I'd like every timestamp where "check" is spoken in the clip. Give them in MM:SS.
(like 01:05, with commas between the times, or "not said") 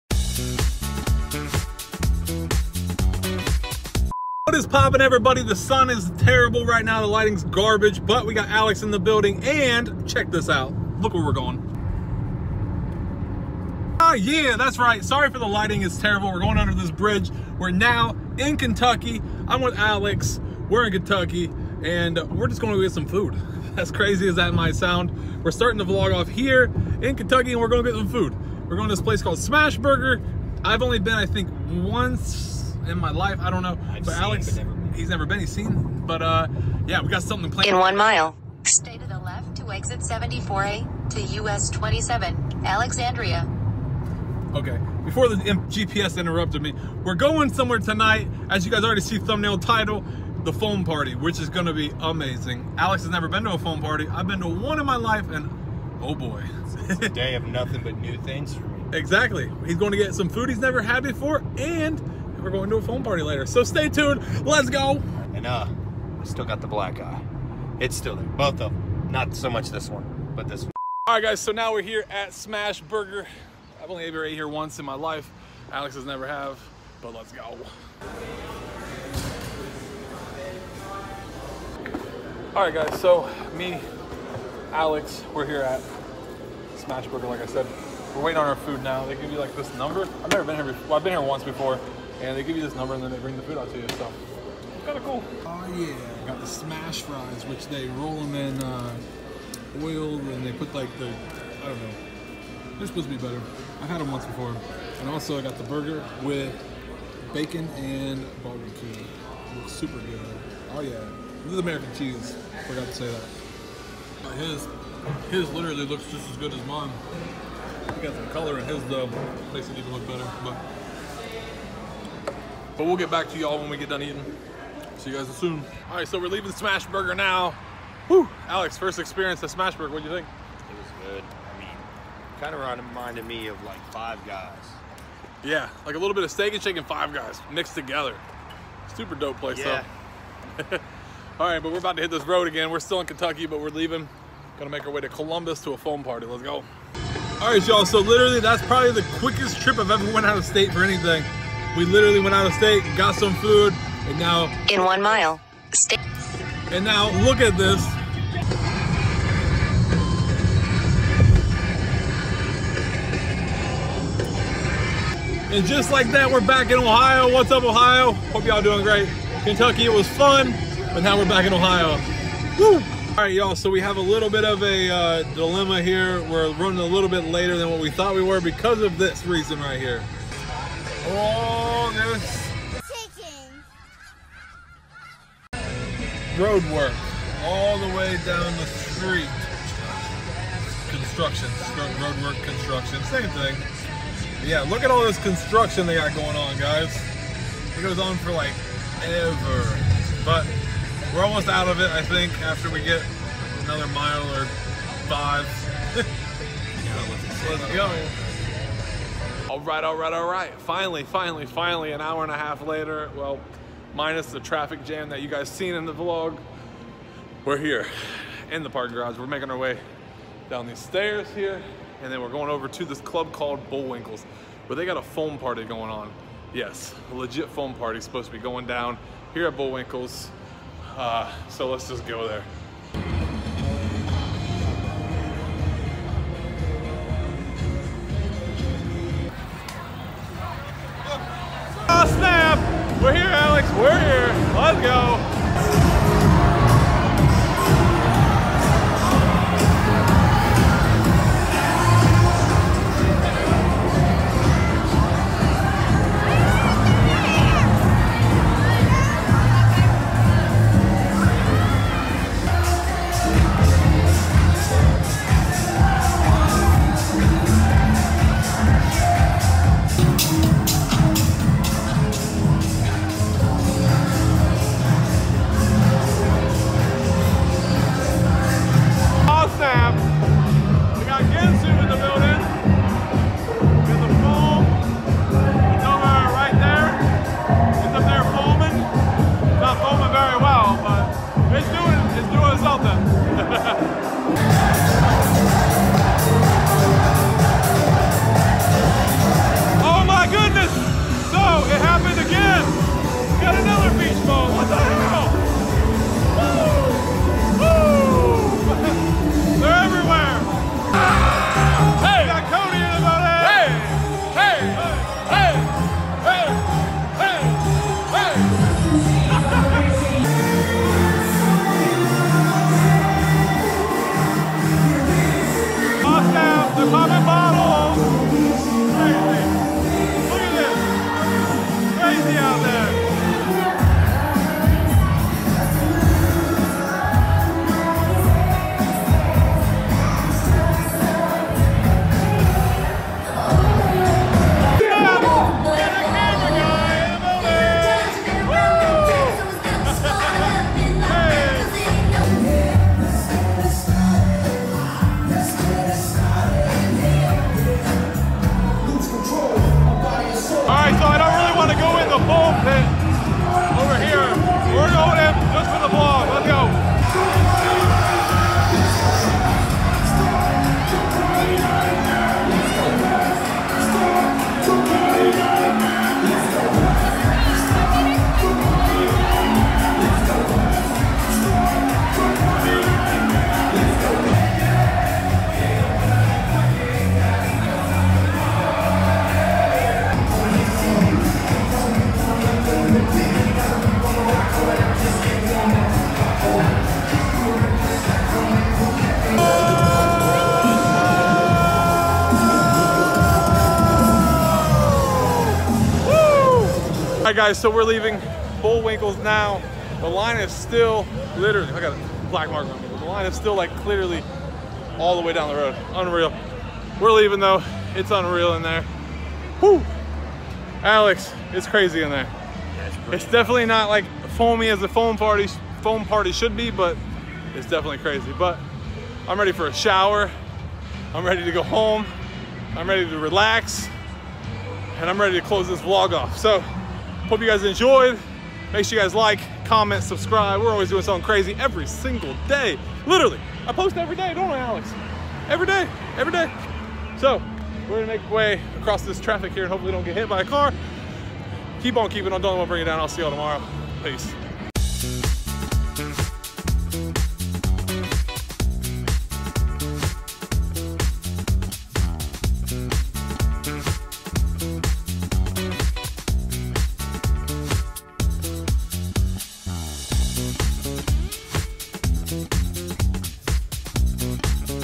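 00:10.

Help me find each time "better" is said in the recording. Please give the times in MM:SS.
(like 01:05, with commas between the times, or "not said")
01:43, 02:00.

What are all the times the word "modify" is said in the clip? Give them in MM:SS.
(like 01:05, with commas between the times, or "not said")
not said.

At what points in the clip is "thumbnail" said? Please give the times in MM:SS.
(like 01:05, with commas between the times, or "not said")
00:49.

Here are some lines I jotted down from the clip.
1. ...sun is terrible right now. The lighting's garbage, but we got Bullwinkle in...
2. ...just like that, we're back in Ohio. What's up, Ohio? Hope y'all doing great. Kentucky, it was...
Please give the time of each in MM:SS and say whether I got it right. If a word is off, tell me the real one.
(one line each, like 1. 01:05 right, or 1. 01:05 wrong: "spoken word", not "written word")
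1. 00:05 wrong: "Alex", not "Bullwinkle"
2. 02:45 right.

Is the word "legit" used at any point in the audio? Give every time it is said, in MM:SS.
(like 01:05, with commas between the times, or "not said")
03:47.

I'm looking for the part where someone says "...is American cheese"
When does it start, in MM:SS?
01:51.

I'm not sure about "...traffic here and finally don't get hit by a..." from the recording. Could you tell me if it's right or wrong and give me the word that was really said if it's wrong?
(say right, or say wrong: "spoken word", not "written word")
wrong: "hopefully", not "finally".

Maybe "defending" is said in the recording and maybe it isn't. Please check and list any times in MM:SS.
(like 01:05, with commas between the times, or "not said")
not said.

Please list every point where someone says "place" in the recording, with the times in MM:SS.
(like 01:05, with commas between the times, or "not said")
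00:29, 02:19.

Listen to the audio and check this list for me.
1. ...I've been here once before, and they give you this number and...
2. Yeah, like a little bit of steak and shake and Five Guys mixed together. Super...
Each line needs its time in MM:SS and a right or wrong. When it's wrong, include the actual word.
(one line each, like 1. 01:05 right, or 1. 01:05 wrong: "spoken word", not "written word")
1. 01:30 right
2. 02:15 right.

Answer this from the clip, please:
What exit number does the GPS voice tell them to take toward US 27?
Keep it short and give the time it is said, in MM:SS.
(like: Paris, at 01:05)
74A, at 00:39.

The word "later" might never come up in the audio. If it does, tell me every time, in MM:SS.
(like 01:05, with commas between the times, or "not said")
01:03, 02:57, 03:32.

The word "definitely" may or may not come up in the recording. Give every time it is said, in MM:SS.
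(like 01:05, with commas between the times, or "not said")
07:03, 07:07.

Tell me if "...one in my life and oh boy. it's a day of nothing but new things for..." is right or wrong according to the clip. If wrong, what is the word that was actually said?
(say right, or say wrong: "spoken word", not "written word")
right.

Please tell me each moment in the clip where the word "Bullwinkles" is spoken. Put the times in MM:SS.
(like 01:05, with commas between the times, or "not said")
03:43, 03:49, 06:48.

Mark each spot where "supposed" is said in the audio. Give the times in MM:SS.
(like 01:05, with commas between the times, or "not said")
01:42, 03:47.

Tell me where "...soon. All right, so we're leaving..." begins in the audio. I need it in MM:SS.
02:05.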